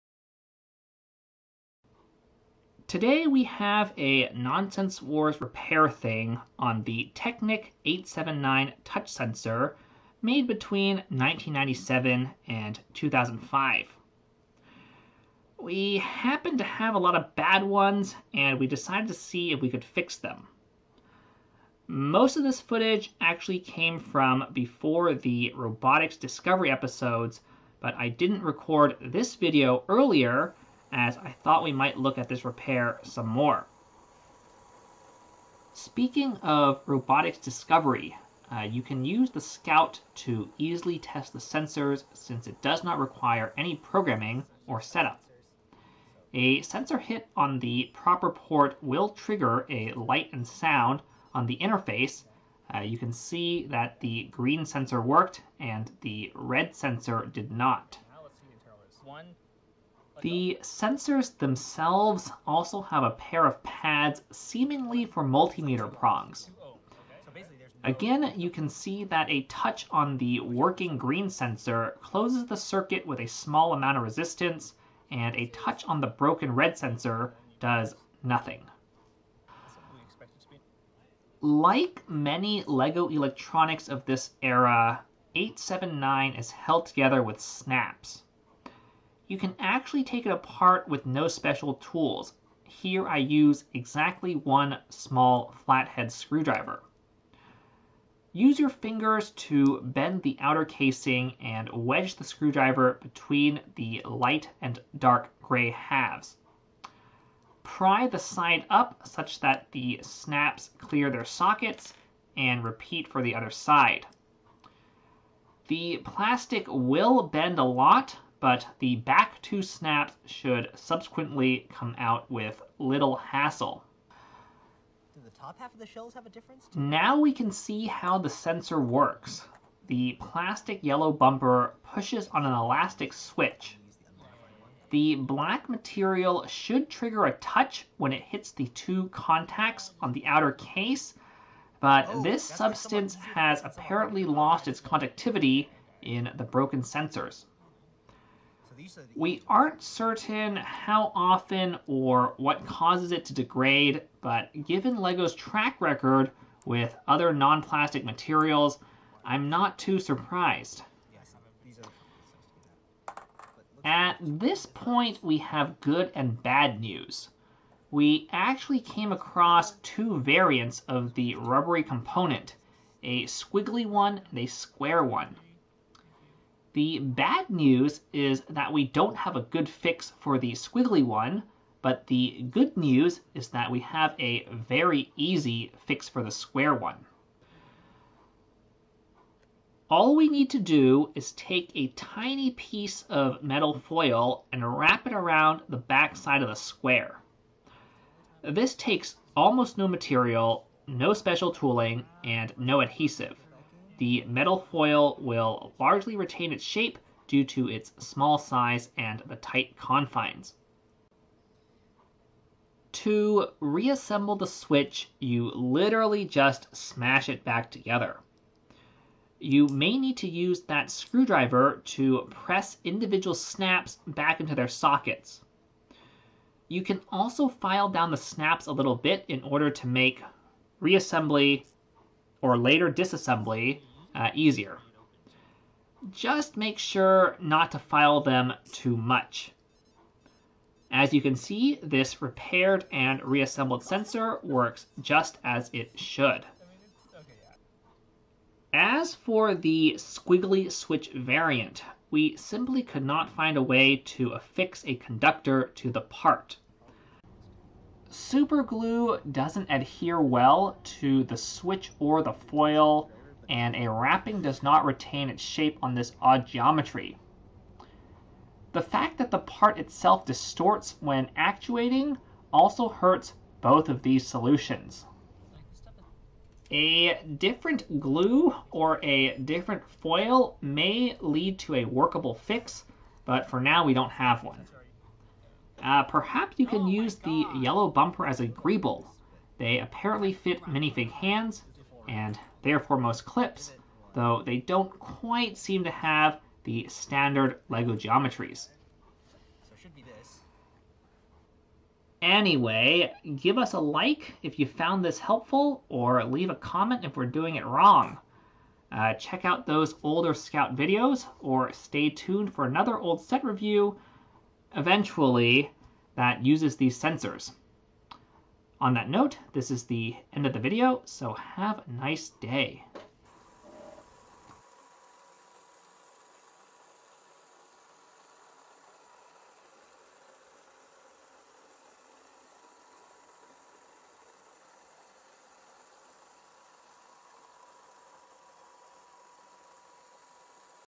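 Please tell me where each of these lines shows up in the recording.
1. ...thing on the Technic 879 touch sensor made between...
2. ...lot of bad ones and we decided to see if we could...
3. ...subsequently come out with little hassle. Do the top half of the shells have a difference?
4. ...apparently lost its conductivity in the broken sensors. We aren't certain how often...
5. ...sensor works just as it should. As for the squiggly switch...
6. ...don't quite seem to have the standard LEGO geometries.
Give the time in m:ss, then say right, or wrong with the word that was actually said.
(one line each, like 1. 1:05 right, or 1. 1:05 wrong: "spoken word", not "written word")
1. 0:05 right
2. 0:16 right
3. 2:00 right
4. 2:23 right
5. 4:03 right
6. 4:54 right.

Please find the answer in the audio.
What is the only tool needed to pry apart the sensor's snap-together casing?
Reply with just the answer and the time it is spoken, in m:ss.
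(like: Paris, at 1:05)
small flathead screwdriver, at 1:34.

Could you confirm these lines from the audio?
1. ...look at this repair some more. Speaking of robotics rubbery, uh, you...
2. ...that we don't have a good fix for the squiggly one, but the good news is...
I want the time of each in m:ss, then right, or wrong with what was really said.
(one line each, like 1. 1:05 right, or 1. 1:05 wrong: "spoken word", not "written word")
1. 0:31 wrong: "discovery", not "rubbery"
2. 2:58 right.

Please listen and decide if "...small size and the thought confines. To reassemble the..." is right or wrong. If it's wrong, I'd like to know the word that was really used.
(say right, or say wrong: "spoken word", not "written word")
wrong: "tight", not "thought".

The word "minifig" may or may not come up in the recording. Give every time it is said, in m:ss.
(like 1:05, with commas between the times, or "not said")
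4:50.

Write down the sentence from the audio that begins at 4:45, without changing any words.
Uh, perhaps you can oh use the yellow bumper as a greeble.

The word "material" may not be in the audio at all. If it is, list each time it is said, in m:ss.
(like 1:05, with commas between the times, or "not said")
2:15, 2:38, 3:19.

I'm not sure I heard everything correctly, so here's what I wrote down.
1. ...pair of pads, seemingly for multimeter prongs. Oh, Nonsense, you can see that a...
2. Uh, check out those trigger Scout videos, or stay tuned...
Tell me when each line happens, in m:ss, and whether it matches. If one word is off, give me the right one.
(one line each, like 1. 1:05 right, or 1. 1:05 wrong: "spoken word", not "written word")
1. 1:03 wrong: "Again", not "Nonsense"
2. 5:08 wrong: "older", not "trigger".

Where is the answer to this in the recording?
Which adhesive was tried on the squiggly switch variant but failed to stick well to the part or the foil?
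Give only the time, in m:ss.
4:18.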